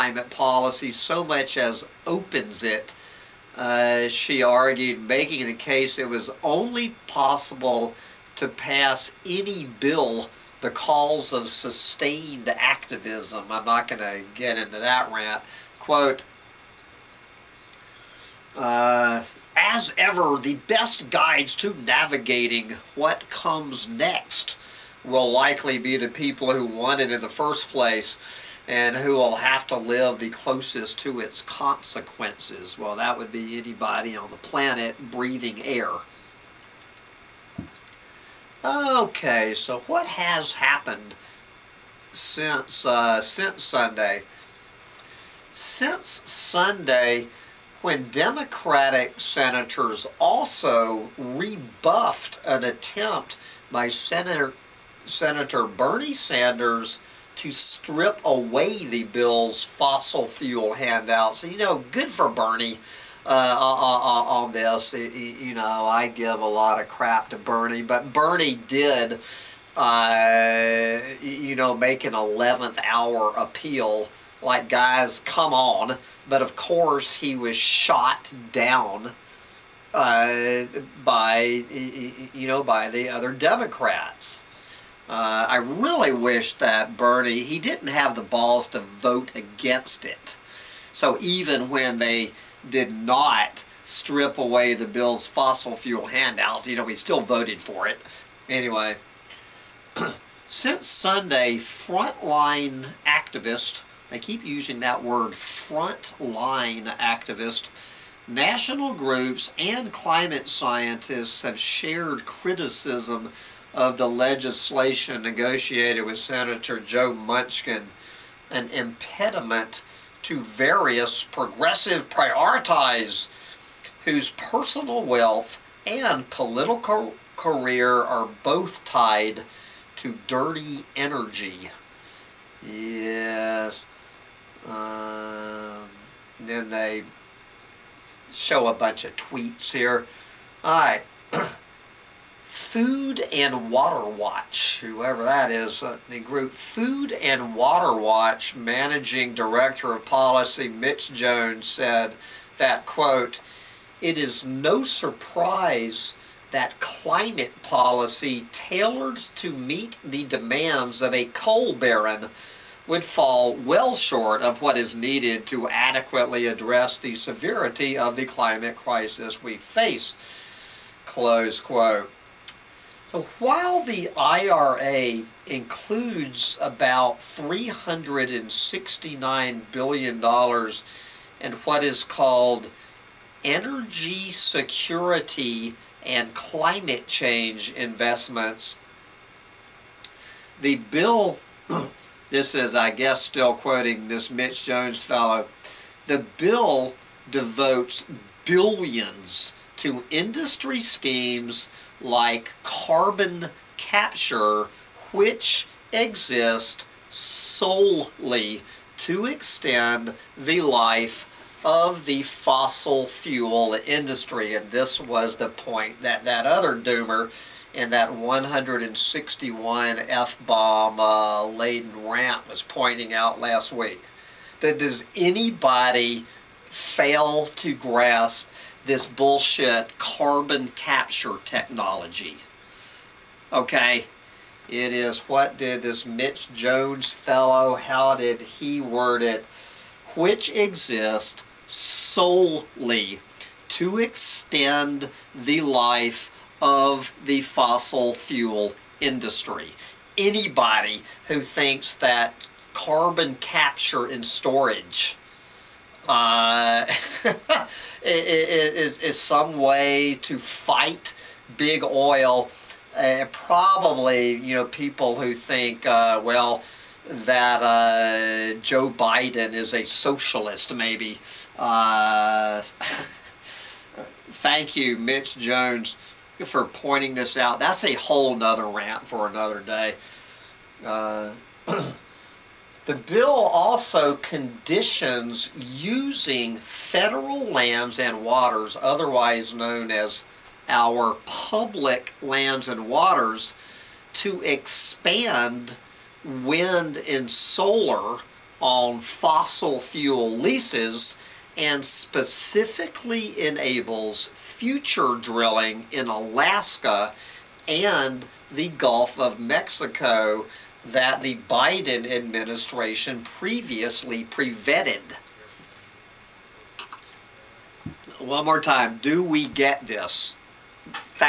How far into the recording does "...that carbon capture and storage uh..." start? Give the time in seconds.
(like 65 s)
251 s.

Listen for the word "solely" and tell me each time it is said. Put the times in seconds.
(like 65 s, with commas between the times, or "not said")
207 s, 241 s.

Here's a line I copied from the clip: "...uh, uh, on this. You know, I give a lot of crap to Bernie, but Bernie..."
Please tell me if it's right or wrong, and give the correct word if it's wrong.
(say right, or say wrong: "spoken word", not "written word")
right.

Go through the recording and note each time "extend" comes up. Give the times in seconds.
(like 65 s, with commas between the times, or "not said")
209 s, 243 s.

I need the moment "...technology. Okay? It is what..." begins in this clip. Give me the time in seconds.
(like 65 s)
231 s.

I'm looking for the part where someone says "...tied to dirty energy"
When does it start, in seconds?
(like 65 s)
128 s.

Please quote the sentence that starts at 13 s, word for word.
I'm not going to get into that rant.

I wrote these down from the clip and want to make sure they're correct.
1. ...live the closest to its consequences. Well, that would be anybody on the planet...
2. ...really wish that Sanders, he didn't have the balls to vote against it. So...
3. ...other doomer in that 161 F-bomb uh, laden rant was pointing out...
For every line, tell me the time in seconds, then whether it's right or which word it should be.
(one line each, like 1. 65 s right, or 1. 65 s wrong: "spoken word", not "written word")
1. 29 s right
2. 85 s wrong: "Bernie", not "Sanders"
3. 216 s right.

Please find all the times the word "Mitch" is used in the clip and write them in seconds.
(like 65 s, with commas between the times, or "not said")
150 s, 194 s, 236 s, 274 s.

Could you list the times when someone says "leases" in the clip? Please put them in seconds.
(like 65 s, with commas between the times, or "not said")
300 s.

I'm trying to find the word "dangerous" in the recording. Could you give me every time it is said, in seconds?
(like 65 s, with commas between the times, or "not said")
not said.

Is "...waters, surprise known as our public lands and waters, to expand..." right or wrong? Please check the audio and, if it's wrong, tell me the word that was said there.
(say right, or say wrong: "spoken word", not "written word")
wrong: "otherwise", not "surprise".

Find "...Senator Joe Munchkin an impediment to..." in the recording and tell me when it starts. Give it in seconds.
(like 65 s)
116 s.